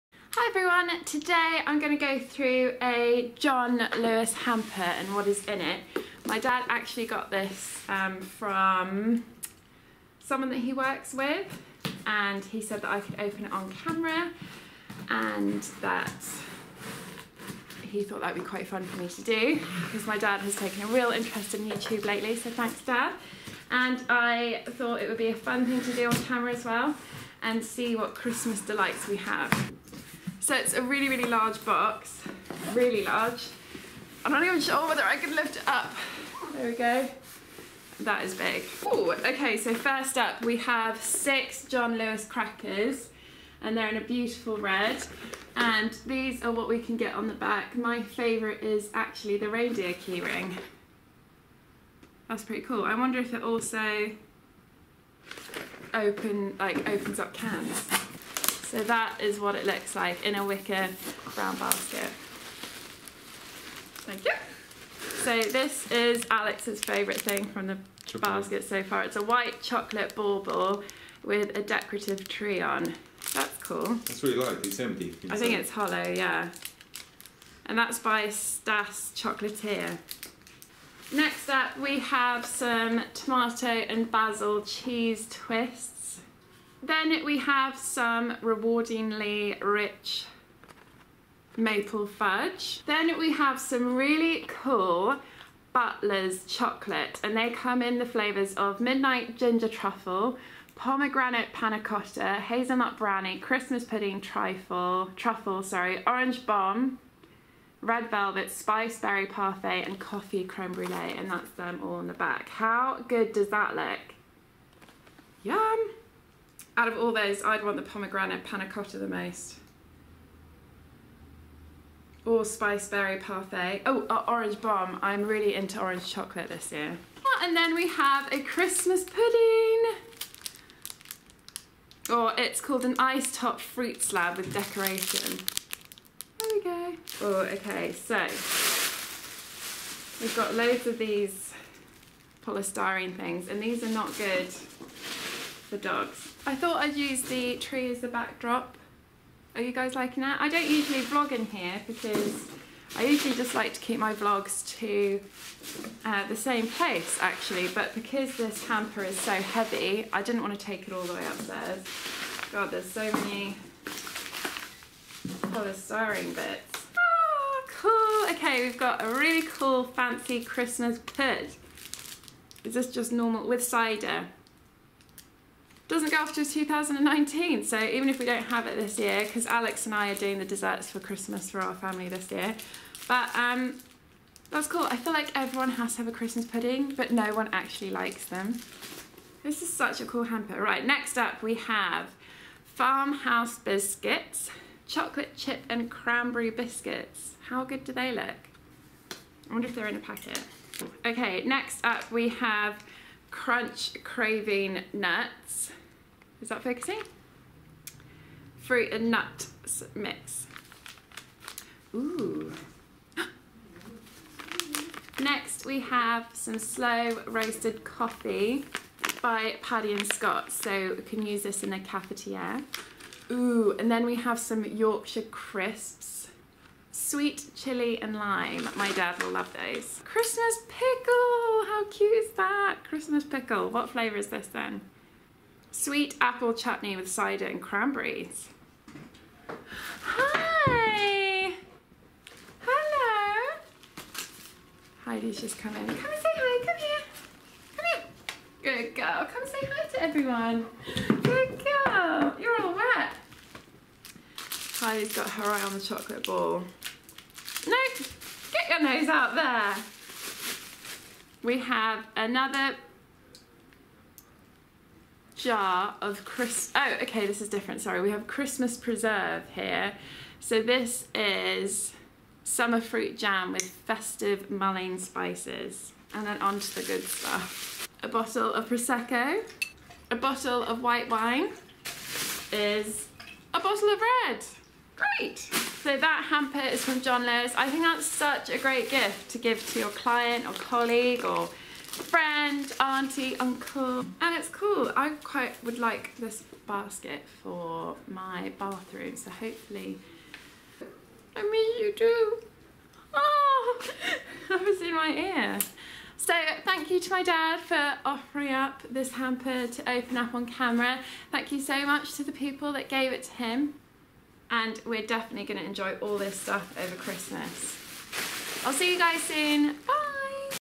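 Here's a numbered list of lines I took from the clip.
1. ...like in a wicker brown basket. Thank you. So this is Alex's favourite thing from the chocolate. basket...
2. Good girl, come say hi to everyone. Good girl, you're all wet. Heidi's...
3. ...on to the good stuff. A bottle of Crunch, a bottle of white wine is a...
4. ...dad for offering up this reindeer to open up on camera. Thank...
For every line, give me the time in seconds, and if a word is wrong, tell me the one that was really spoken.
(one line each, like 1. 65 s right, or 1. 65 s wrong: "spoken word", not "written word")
1. 59 s right
2. 248 s right
3. 276 s wrong: "Prosecco", not "Crunch"
4. 307 s wrong: "hamper", not "reindeer".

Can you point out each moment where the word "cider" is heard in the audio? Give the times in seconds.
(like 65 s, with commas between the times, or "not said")
173 s, 237 s.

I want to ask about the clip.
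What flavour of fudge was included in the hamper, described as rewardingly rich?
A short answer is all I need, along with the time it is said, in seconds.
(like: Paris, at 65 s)
Maple, at 91 s.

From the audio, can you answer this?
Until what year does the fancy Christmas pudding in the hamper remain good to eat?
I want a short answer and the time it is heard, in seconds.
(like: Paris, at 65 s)
2019, at 176 s.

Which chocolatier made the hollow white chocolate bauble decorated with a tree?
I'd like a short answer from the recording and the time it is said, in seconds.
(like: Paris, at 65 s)
Stas Chocolatier, at 78 s.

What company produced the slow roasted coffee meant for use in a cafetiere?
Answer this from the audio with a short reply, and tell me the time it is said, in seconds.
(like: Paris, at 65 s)
Paddy and Scott, at 219 s.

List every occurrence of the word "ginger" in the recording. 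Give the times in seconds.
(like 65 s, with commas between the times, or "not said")
99 s.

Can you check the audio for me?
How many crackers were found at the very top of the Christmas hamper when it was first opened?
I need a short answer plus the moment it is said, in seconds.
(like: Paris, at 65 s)
6, at 40 s.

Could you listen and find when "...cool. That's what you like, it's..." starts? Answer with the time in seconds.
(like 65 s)
73 s.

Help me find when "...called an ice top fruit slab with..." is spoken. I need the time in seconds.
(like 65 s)
132 s.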